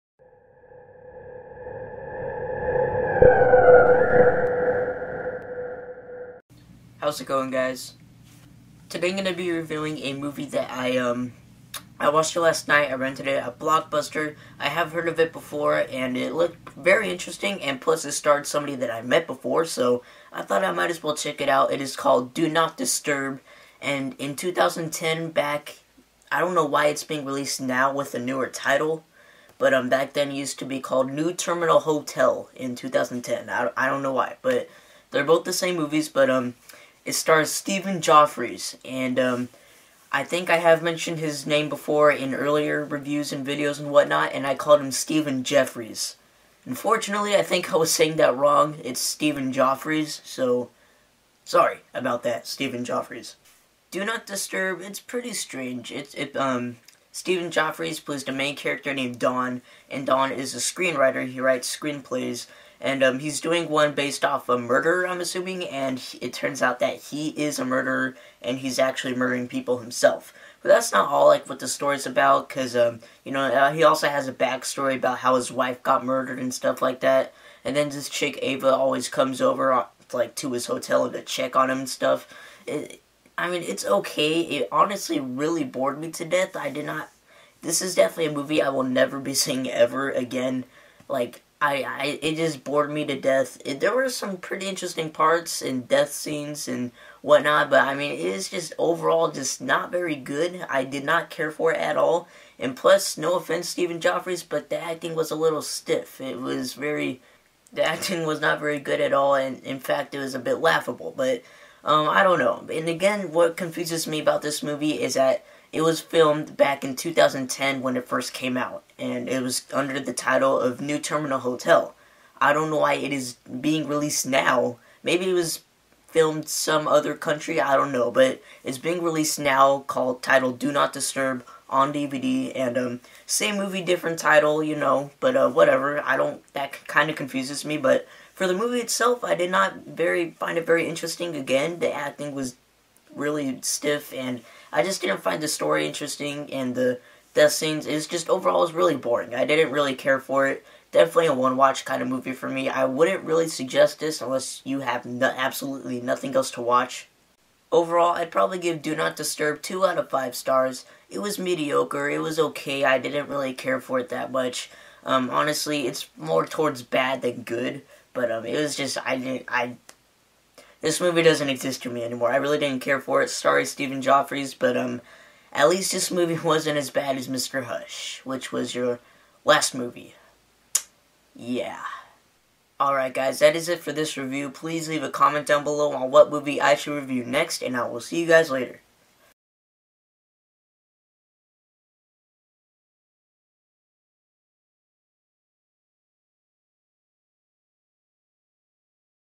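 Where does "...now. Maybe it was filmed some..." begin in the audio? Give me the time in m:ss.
2:04.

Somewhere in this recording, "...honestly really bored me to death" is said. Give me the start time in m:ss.
1:24.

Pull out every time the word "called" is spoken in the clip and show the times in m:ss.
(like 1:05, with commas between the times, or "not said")
0:21, 0:30, 0:44, 2:09.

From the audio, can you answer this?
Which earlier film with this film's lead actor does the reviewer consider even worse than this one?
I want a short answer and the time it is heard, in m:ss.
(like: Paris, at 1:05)
Mr. Hush, at 2:57.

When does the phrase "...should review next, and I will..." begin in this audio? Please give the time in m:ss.
3:06.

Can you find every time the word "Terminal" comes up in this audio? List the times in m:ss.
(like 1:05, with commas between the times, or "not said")
0:31, 2:00.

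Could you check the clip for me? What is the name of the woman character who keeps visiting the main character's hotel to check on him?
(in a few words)
Ava.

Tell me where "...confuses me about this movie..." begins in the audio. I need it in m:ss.
1:53.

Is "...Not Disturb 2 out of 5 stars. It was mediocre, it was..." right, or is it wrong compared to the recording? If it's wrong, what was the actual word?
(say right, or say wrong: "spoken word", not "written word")
right.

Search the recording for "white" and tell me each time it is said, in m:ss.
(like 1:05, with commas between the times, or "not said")
not said.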